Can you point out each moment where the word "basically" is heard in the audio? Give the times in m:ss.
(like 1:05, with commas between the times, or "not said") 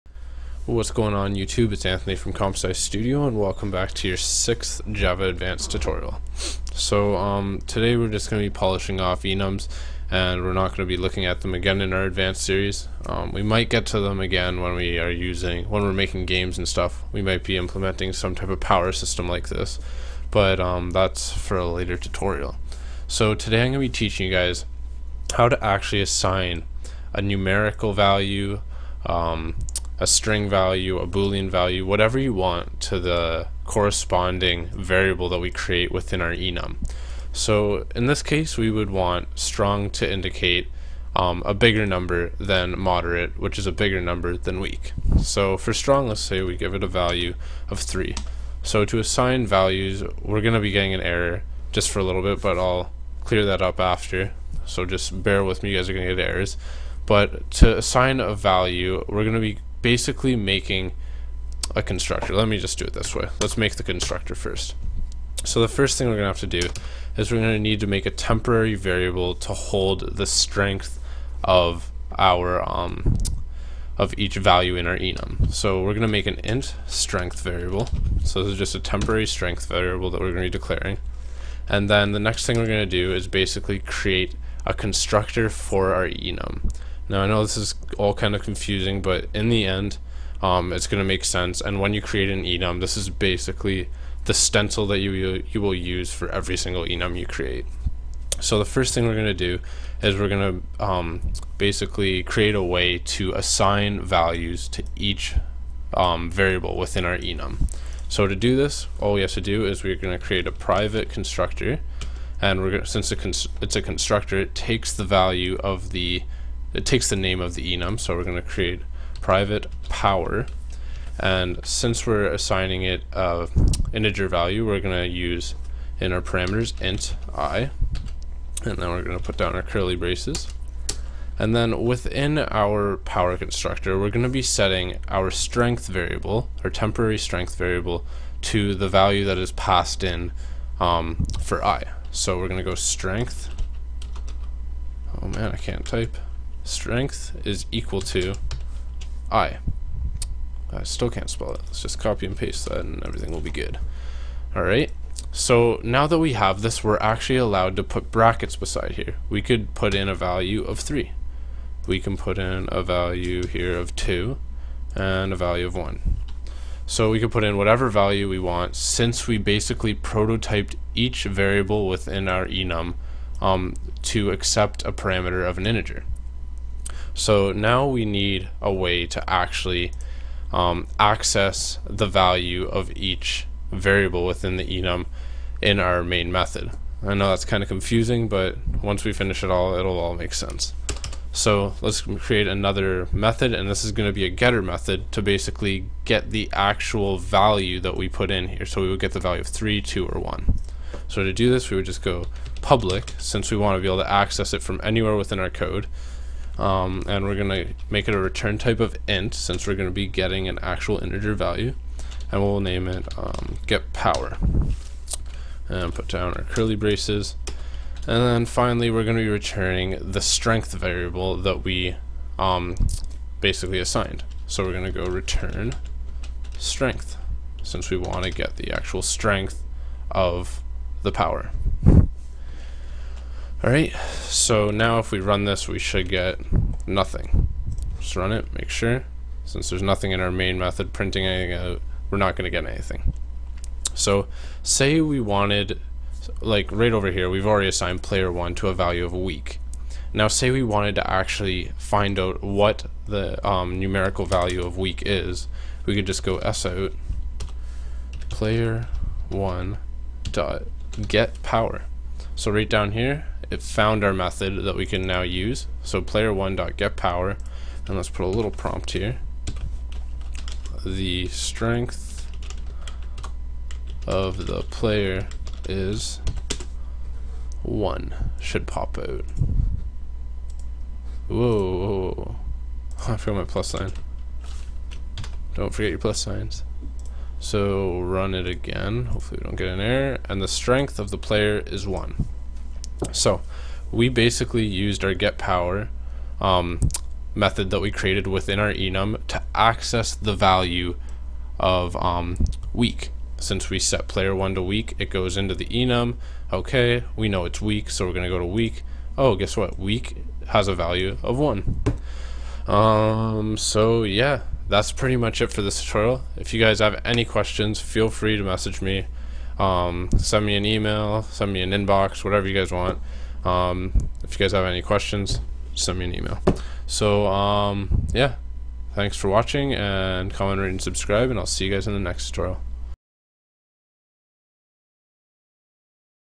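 0:59, 1:23, 1:33, 1:41, 2:49, 3:15, 3:43, 4:54.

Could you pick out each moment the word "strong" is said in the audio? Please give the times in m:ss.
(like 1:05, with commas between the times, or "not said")
0:39, 0:45.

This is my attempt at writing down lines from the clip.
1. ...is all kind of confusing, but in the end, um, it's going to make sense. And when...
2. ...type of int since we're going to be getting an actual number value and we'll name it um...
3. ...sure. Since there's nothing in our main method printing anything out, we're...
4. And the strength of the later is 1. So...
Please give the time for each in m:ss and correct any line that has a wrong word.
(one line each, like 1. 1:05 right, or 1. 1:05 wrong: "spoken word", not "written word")
1. 1:27 right
2. 3:28 wrong: "integer", not "number"
3. 3:58 right
4. 4:50 wrong: "player", not "later".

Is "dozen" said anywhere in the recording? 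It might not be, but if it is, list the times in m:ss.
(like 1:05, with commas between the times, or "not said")
not said.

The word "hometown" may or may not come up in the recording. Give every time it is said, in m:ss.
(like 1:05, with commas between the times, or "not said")
not said.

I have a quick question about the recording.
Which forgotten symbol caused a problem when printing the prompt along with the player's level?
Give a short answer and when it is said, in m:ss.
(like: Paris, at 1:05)
plus sign, at 4:43.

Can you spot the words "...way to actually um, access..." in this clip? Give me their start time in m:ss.
2:58.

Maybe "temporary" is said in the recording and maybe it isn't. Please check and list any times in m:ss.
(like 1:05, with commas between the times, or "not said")
1:08, 1:18, 2:16.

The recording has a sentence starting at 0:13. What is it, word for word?
Um, we might get to them again when we are using, when we're making games and stuff.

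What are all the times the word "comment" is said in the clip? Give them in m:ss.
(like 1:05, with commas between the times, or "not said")
5:30.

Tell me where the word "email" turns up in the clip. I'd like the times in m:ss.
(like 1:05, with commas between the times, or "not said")
5:20, 5:26.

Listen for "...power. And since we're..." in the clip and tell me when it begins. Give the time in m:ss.
1:59.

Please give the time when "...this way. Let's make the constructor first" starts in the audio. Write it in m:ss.
1:02.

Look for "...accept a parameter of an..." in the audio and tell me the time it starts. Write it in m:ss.
2:54.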